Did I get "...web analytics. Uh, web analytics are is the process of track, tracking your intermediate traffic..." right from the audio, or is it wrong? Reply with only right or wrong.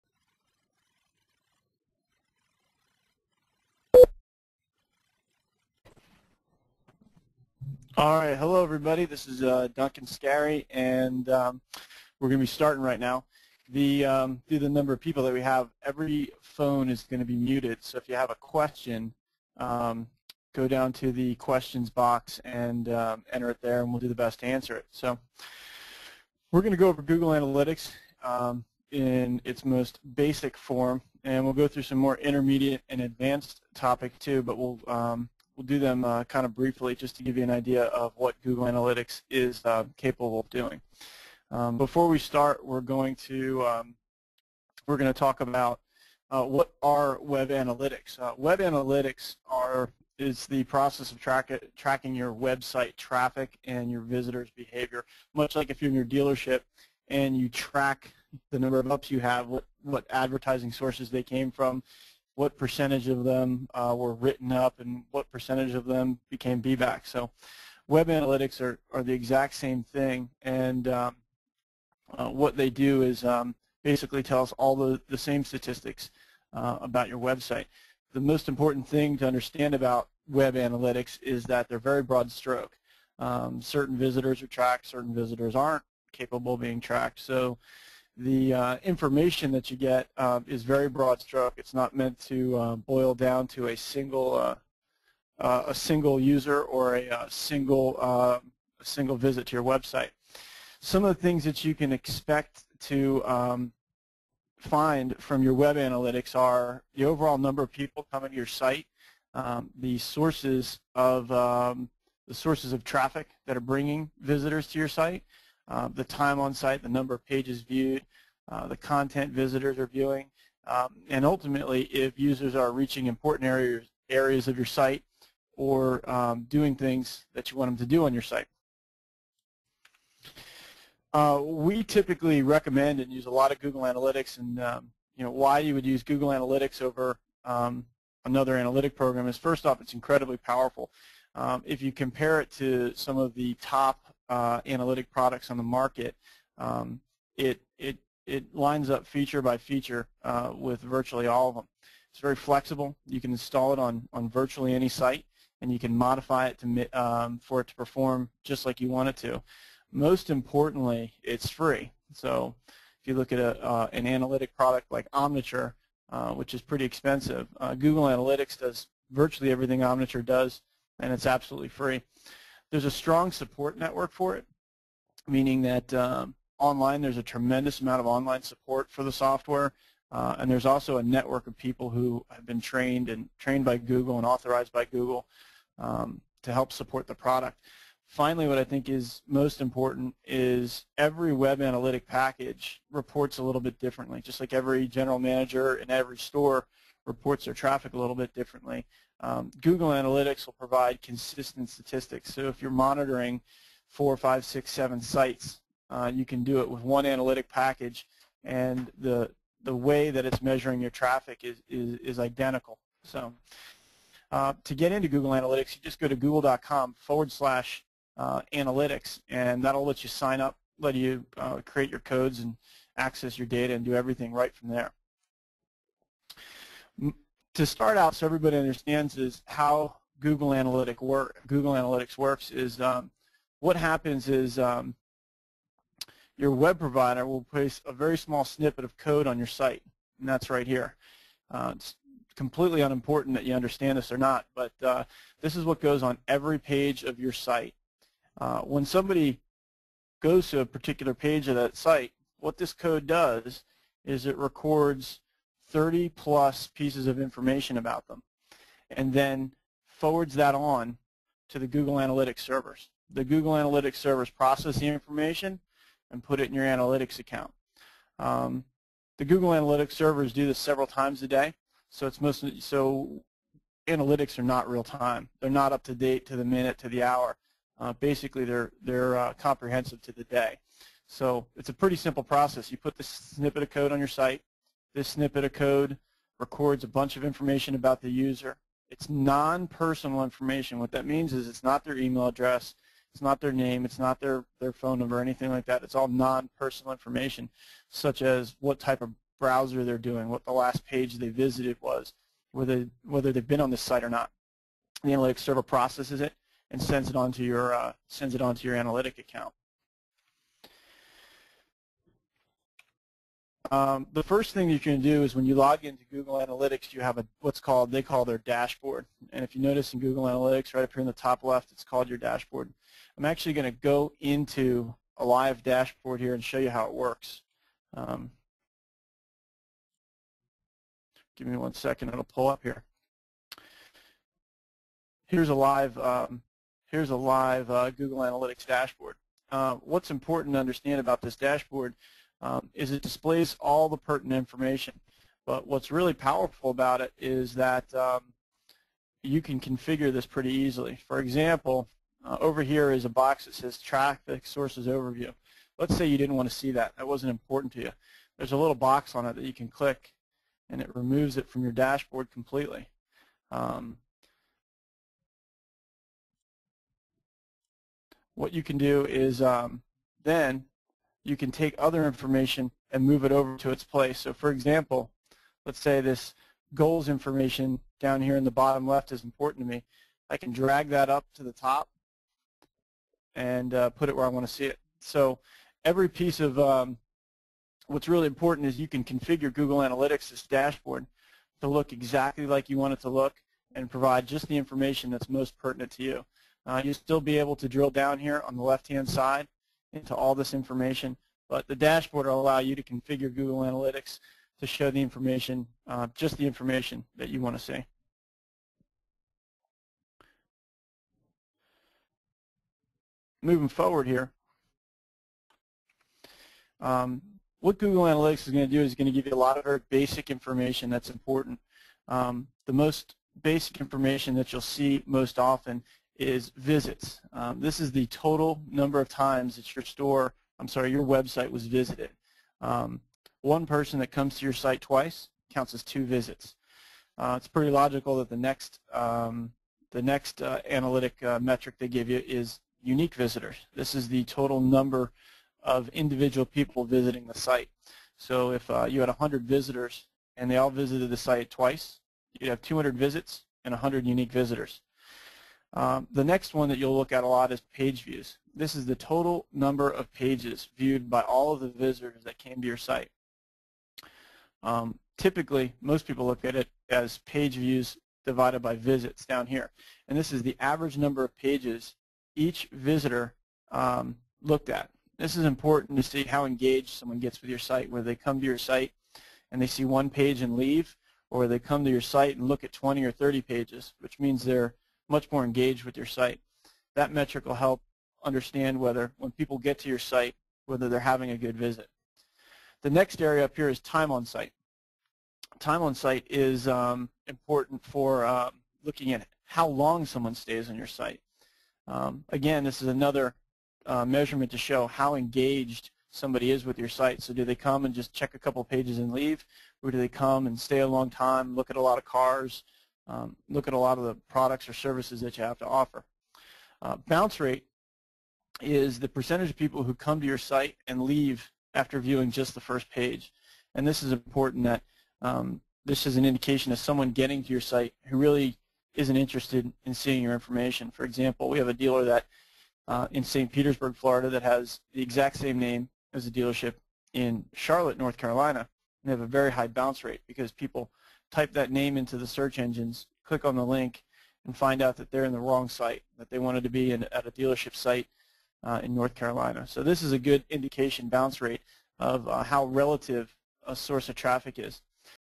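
wrong.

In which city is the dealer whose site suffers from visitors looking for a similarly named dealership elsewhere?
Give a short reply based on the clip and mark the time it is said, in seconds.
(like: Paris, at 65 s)
St. Petersburg, at 533 s.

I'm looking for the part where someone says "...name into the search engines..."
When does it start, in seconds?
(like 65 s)
541 s.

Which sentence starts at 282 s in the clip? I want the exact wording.
You put the snippet of code on your site, this snippet of code records a bunch of information about the user.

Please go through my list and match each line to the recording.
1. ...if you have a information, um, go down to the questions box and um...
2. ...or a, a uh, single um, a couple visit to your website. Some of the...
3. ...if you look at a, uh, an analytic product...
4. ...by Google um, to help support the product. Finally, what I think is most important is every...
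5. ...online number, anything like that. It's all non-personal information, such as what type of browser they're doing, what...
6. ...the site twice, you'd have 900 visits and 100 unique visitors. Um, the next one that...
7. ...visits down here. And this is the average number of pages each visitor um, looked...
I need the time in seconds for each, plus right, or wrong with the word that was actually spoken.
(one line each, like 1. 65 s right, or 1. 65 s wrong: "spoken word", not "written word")
1. 17 s wrong: "question", not "information"
2. 96 s wrong: "single", not "couple"
3. 162 s right
4. 184 s right
5. 294 s wrong: "phone", not "online"
6. 451 s wrong: "200", not "900"
7. 468 s right.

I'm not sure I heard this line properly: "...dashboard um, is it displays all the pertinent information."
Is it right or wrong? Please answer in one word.
right.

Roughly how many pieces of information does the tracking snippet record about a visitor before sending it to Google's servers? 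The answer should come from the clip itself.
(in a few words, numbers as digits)
30 plus.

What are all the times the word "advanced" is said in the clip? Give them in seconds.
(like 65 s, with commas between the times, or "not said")
33 s.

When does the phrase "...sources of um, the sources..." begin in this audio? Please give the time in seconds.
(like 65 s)
109 s.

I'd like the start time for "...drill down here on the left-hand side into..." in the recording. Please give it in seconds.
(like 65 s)
397 s.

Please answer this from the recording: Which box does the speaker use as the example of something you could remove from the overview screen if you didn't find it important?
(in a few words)
Traffic Sources Overview.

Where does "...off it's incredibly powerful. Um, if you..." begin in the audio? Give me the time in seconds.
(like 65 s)
139 s.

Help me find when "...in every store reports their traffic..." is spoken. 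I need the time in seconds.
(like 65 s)
195 s.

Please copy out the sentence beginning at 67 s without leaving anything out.
So web analytics are, are the exact same thing.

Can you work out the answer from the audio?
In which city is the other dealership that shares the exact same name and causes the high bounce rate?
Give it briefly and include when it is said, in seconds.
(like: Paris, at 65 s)
Charlotte, at 537 s.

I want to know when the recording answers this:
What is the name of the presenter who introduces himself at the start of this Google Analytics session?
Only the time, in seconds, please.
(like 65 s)
9 s.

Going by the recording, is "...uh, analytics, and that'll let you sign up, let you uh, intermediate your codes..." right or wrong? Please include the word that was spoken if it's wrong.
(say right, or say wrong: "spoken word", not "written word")
wrong: "create", not "intermediate".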